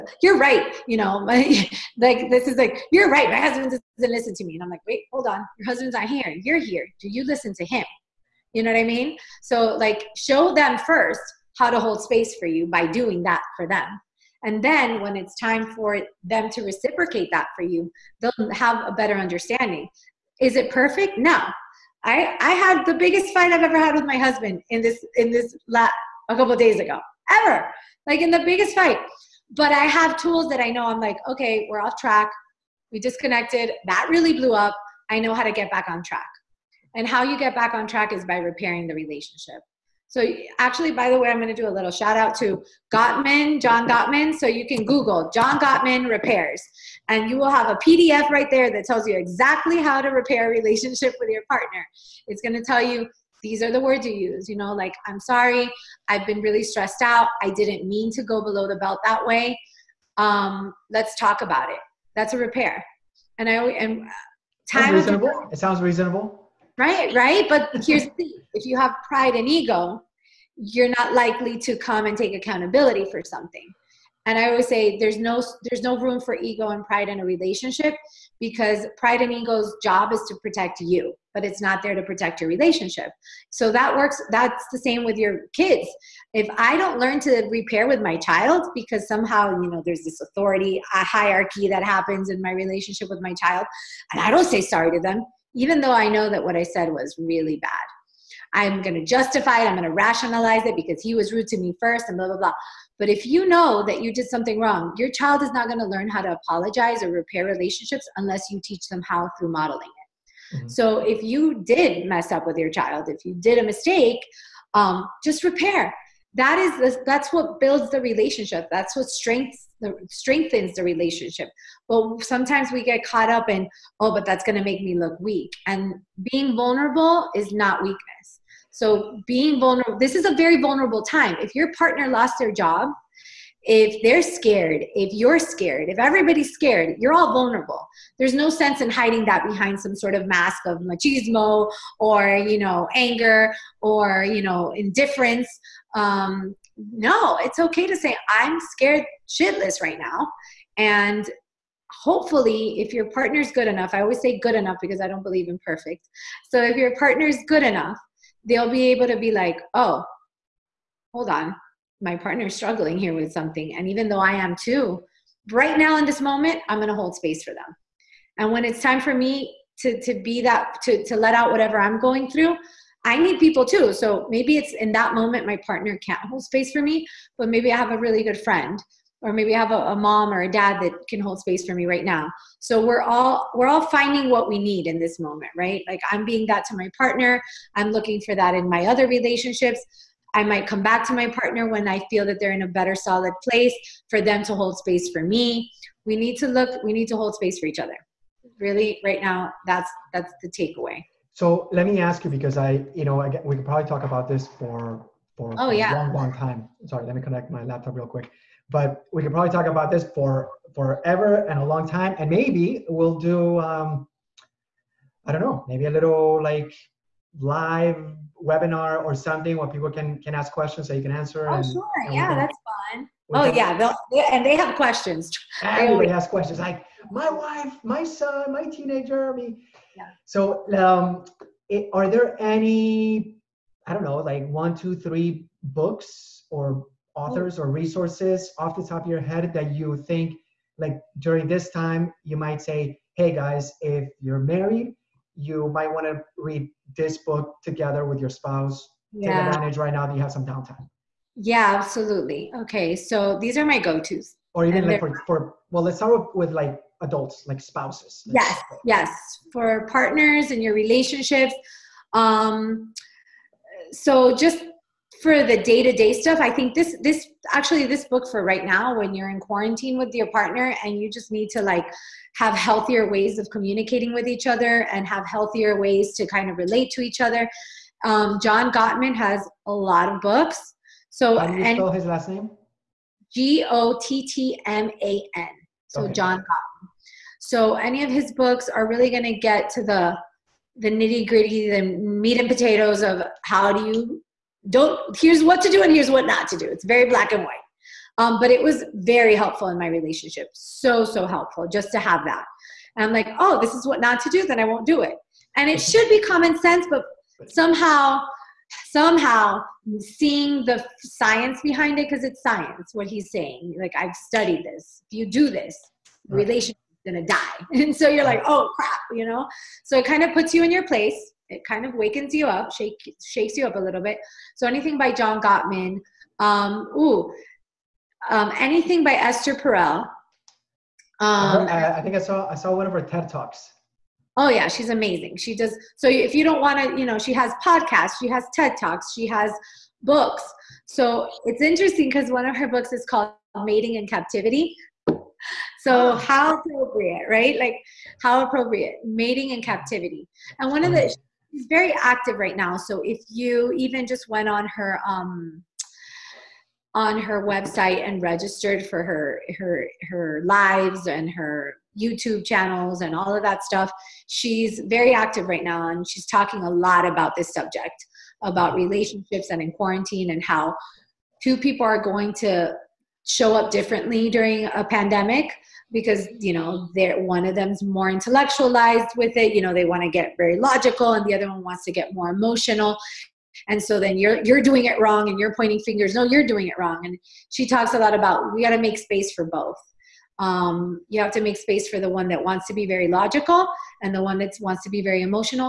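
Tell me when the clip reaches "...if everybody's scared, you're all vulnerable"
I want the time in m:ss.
2:15.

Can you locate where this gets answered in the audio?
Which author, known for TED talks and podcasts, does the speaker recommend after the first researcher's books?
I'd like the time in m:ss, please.
5:29.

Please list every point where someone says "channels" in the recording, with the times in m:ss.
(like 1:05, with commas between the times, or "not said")
6:02.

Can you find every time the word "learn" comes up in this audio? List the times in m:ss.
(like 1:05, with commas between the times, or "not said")
1:26, 1:45.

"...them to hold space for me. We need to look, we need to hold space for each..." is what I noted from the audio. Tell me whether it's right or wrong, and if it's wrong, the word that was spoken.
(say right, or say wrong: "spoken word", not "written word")
right.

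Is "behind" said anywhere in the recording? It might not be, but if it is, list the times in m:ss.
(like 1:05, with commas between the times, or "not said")
2:19, 5:11.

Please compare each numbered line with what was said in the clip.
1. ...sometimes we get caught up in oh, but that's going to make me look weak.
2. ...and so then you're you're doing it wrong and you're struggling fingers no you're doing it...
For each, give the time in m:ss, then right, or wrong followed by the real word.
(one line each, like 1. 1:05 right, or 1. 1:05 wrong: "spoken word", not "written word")
1. 2:02 right
2. 6:23 wrong: "pointing", not "struggling".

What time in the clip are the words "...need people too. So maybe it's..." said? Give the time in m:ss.
2:53.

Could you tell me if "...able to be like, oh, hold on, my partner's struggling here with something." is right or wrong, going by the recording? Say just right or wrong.
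right.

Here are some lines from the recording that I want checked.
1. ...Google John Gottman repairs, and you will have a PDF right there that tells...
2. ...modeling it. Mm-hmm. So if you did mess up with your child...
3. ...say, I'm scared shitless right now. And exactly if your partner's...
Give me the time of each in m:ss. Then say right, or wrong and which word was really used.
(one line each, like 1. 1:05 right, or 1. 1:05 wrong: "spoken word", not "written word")
1. 0:44 right
2. 1:49 right
3. 2:27 wrong: "hopefully", not "exactly".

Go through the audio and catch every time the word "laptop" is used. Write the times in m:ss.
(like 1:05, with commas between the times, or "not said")
3:27.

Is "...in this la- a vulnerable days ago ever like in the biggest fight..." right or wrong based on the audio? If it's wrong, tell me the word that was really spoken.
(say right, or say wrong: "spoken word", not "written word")
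wrong: "couple", not "vulnerable".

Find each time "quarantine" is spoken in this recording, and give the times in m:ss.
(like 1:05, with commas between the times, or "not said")
4:29, 6:09.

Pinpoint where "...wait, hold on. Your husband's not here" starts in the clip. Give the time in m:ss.
0:04.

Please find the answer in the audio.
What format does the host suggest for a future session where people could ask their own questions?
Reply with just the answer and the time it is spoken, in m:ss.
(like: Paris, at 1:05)
live webinar, at 3:37.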